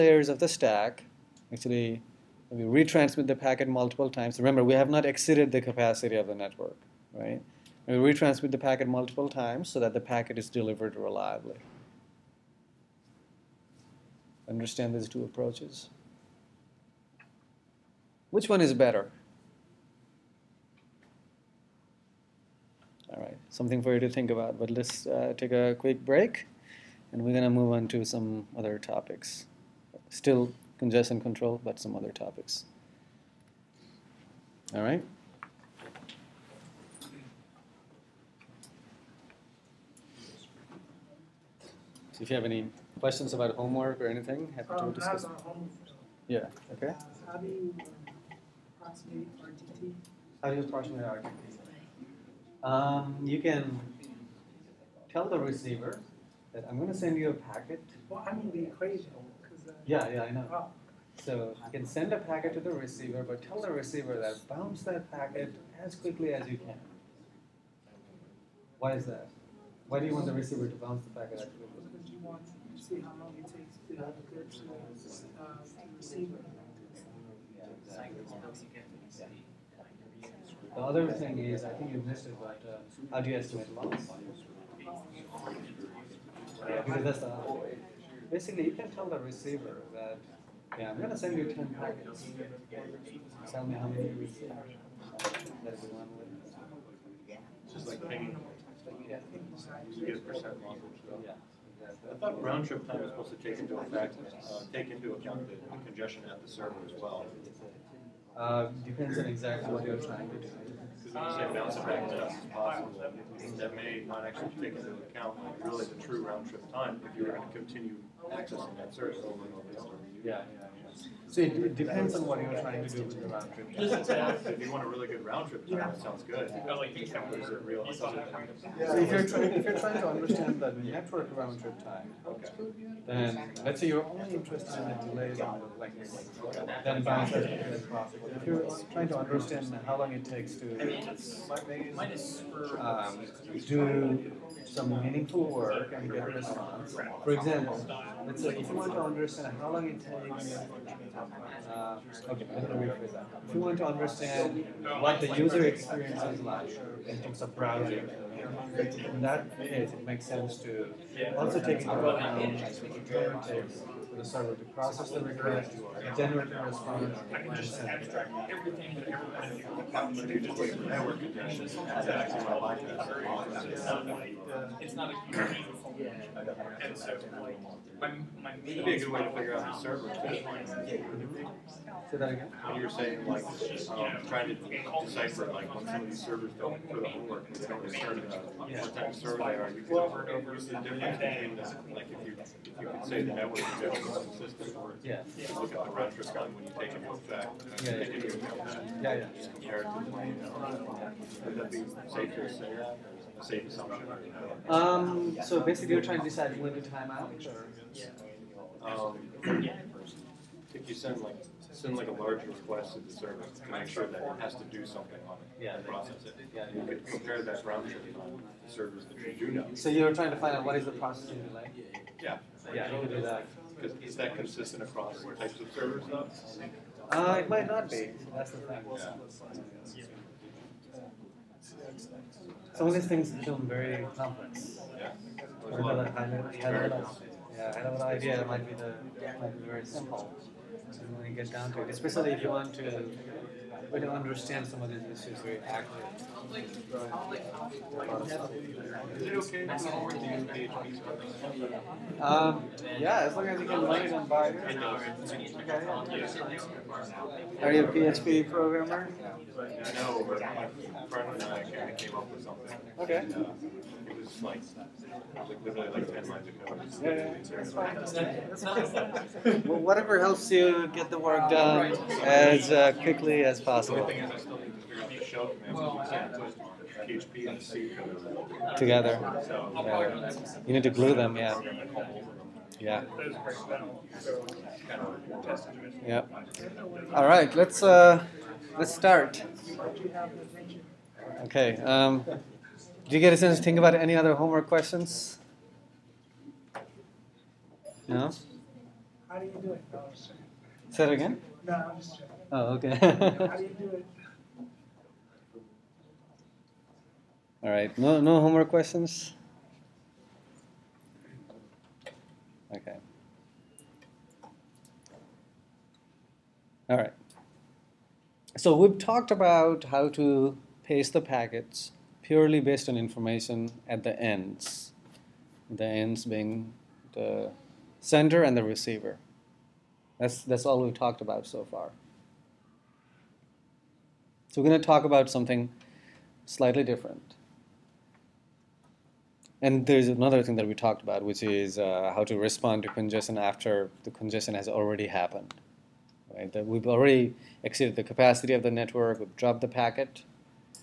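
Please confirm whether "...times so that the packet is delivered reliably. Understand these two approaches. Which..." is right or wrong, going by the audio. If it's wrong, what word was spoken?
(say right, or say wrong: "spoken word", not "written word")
right.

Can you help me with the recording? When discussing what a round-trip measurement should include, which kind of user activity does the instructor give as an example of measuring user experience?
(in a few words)
browsing.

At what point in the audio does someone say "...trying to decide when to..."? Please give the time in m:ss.
3:26.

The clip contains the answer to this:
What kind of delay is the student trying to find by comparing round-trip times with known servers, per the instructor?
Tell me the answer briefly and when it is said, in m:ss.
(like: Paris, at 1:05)
processing delay, at 3:40.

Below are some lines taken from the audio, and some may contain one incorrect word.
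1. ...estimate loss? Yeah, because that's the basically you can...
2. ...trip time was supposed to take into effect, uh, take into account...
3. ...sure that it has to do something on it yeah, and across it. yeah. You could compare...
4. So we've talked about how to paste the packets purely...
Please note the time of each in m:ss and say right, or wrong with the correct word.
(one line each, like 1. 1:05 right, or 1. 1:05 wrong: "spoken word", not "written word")
1. 1:23 right
2. 1:42 right
3. 3:33 wrong: "process", not "across"
4. 5:18 right.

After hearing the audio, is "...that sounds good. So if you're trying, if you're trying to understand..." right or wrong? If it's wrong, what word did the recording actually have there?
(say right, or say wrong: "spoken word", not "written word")
right.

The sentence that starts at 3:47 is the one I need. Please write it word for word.
Uh, it might not be, that's the thing.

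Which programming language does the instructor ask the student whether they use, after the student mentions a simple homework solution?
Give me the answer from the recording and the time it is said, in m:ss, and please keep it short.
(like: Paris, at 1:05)
PHP, at 4:17.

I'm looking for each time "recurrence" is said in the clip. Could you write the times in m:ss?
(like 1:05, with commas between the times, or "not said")
2:45.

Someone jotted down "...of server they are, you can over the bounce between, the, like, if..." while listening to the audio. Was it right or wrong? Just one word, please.
wrong.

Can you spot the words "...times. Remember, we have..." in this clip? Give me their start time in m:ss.
0:04.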